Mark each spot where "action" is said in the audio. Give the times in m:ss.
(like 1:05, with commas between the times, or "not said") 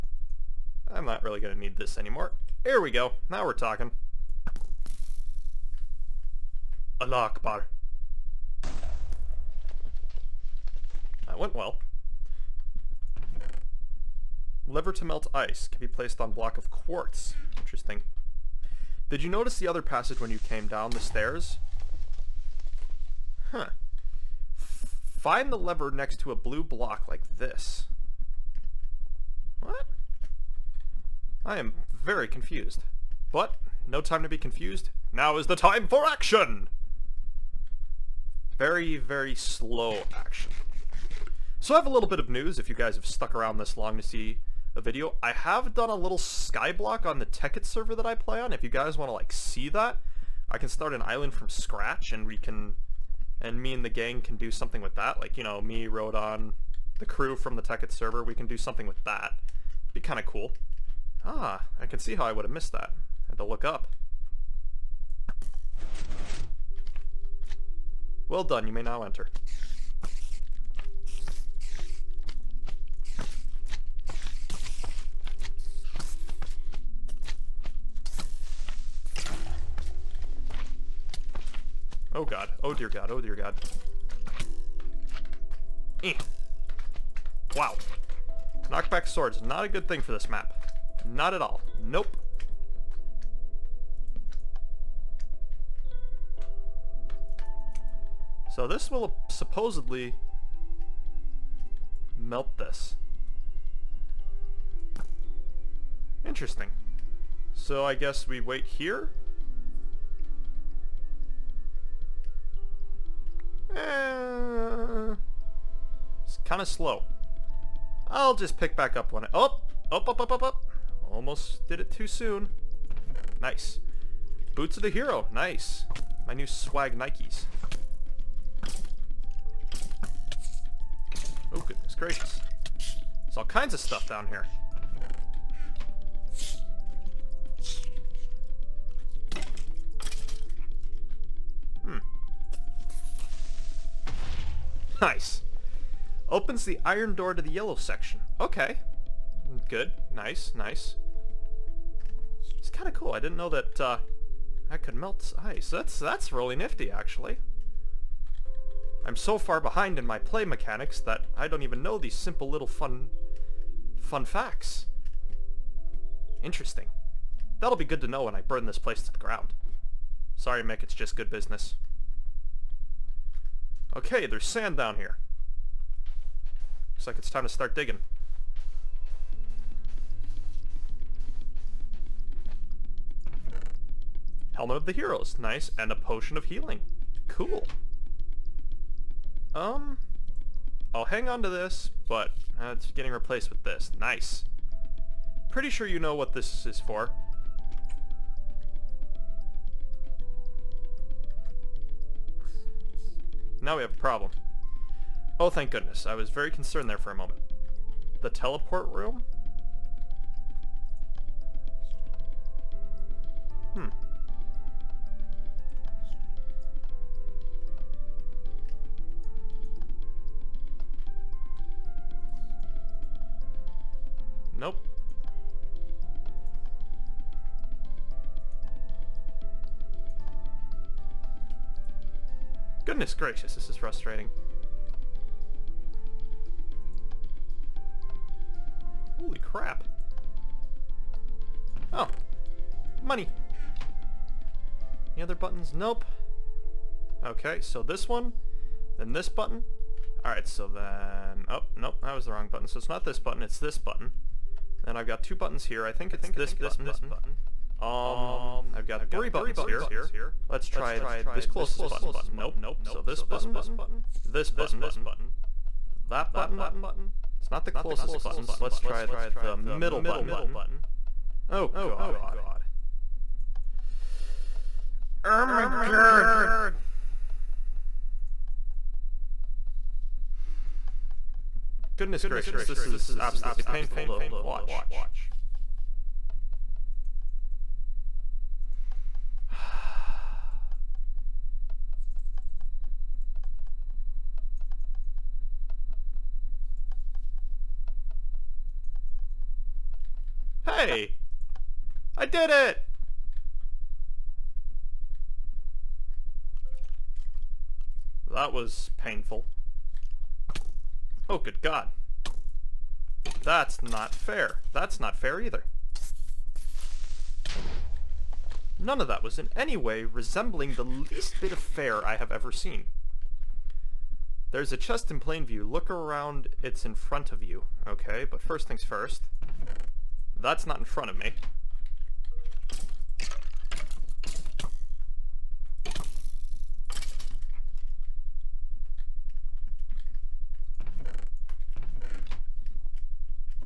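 0:36, 0:40.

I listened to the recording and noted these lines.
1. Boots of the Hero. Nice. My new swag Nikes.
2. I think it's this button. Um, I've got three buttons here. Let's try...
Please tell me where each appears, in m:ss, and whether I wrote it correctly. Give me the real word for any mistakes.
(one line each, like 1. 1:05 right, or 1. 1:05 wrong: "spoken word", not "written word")
1. 2:04 right
2. 4:15 right.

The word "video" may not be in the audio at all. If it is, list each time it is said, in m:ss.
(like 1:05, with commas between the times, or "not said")
0:44.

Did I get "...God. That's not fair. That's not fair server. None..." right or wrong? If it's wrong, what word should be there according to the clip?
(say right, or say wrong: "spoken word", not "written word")
wrong: "either", not "server".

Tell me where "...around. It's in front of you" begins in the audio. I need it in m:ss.
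5:25.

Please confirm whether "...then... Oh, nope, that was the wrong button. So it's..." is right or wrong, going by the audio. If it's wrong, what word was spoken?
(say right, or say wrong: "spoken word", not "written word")
right.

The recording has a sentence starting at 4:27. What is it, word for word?
It's not the closest button, so let's try the middle button.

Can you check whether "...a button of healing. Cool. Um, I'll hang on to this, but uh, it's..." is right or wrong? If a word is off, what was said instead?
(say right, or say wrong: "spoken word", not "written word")
wrong: "potion", not "button".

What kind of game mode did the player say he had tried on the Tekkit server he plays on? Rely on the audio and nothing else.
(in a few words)
Skyblock.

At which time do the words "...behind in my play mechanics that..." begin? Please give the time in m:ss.
2:39.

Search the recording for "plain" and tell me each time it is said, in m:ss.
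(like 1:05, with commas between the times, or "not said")
5:25.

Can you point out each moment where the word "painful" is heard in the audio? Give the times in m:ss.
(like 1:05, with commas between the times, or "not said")
4:43, 5:08.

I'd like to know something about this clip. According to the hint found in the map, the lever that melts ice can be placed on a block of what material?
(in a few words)
Quartz.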